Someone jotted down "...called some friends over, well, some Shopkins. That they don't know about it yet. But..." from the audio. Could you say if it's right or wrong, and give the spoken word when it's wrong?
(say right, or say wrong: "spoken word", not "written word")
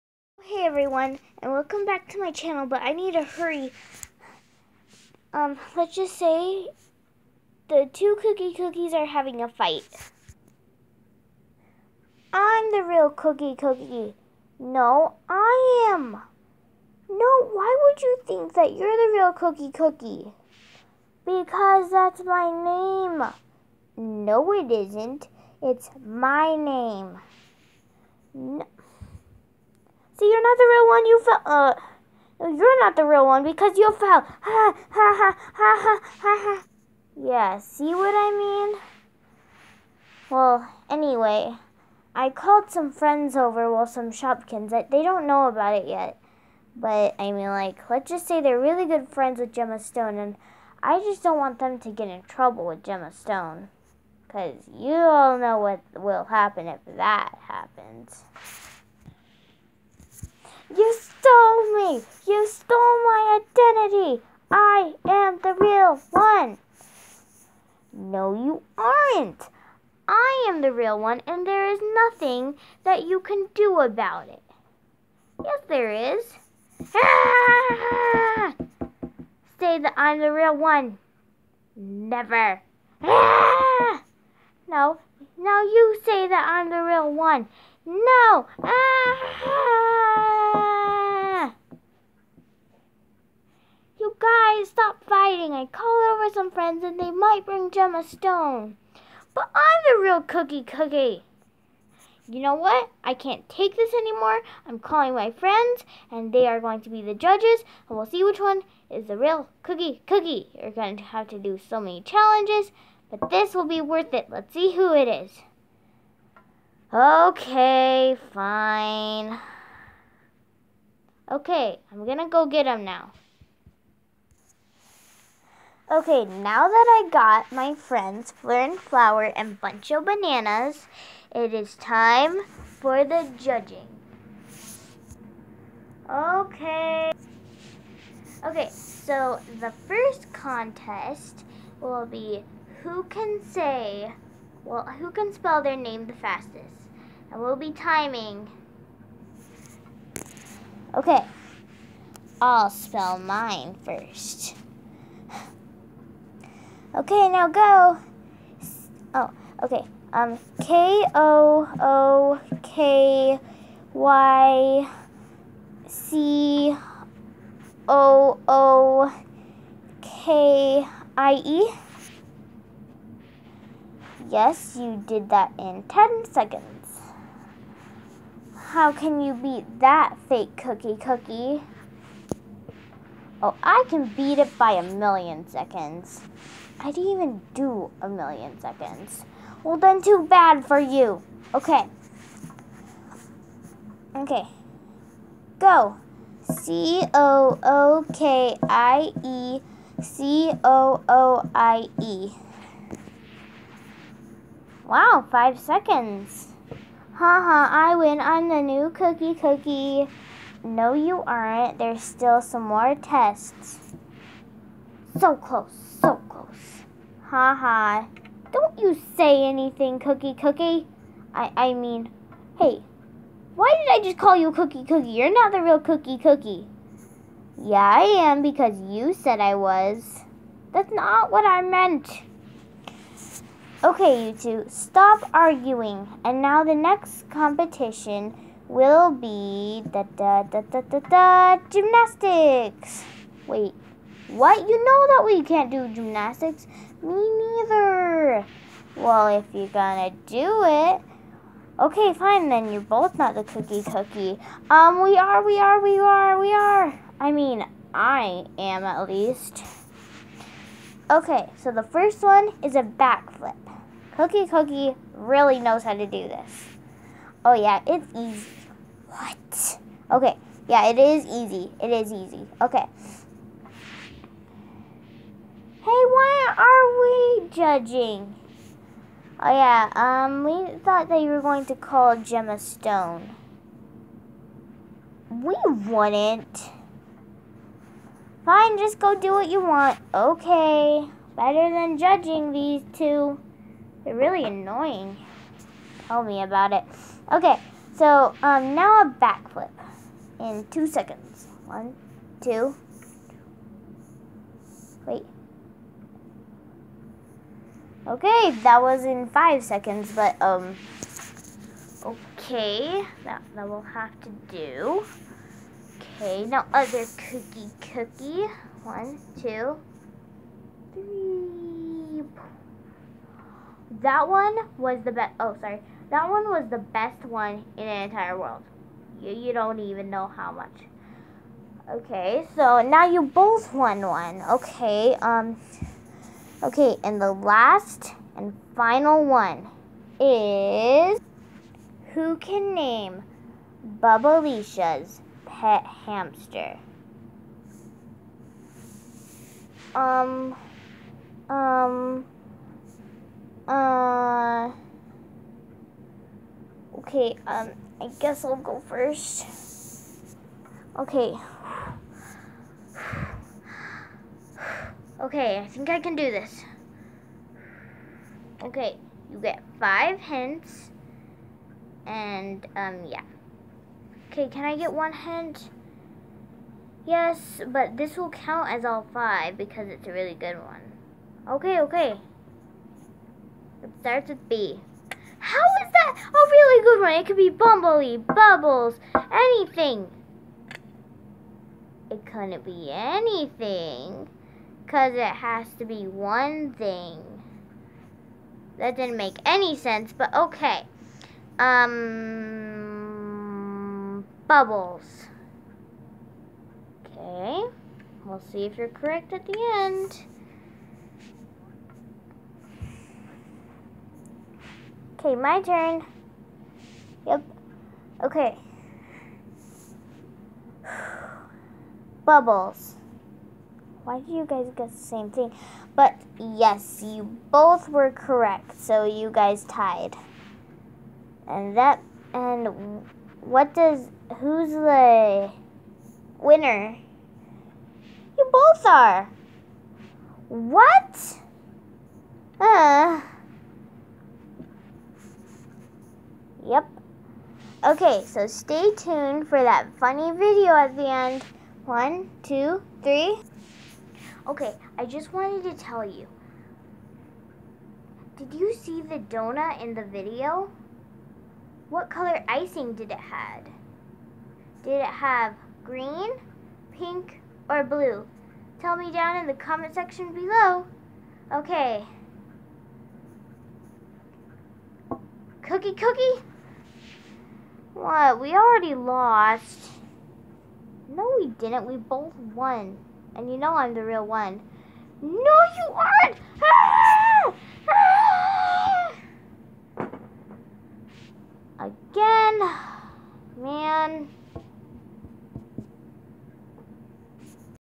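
right.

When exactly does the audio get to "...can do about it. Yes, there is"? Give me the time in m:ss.
1:13.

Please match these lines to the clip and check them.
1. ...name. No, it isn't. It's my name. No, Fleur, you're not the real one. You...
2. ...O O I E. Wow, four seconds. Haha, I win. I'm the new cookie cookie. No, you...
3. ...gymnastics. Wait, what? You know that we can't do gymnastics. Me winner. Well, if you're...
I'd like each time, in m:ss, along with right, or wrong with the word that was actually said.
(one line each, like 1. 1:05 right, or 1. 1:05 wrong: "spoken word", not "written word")
1. 0:22 wrong: "See", not "Fleur"
2. 3:20 wrong: "five", not "four"
3. 4:01 wrong: "neither", not "winner".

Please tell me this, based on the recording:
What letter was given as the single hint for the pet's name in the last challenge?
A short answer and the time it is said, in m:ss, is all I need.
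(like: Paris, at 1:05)
B, at 6:24.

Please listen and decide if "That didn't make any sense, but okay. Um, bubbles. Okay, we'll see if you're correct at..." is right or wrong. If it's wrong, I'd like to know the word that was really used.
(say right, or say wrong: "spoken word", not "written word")
right.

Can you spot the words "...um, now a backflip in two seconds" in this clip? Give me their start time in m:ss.
4:58.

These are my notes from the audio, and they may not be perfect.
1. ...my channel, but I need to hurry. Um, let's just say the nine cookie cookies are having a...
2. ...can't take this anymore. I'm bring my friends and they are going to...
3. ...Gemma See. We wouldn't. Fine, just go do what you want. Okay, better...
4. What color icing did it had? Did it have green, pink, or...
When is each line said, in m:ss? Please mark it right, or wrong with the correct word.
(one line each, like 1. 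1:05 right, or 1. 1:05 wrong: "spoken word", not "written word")
1. 0:02 wrong: "two", not "nine"
2. 1:43 wrong: "calling", not "bring"
3. 4:42 wrong: "Stone", not "See"
4. 7:41 right.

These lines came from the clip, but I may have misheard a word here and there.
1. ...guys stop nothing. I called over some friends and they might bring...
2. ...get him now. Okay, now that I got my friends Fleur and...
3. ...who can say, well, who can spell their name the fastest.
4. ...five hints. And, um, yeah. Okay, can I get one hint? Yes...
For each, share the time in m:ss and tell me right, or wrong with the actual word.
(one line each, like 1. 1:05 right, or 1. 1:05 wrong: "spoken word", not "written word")
1. 1:34 wrong: "fighting", not "nothing"
2. 2:02 right
3. 2:22 right
4. 6:09 right.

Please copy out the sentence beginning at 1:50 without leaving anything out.
You're going to have to do so many challenges, but this will be worth it.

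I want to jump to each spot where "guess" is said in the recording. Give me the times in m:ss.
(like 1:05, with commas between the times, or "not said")
5:58, 7:04.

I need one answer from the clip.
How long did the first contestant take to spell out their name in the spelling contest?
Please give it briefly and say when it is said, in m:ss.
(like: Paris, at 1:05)
10 seconds, at 2:55.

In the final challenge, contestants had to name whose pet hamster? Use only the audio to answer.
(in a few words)
Bubbleisha.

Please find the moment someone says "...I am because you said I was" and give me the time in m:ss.
3:47.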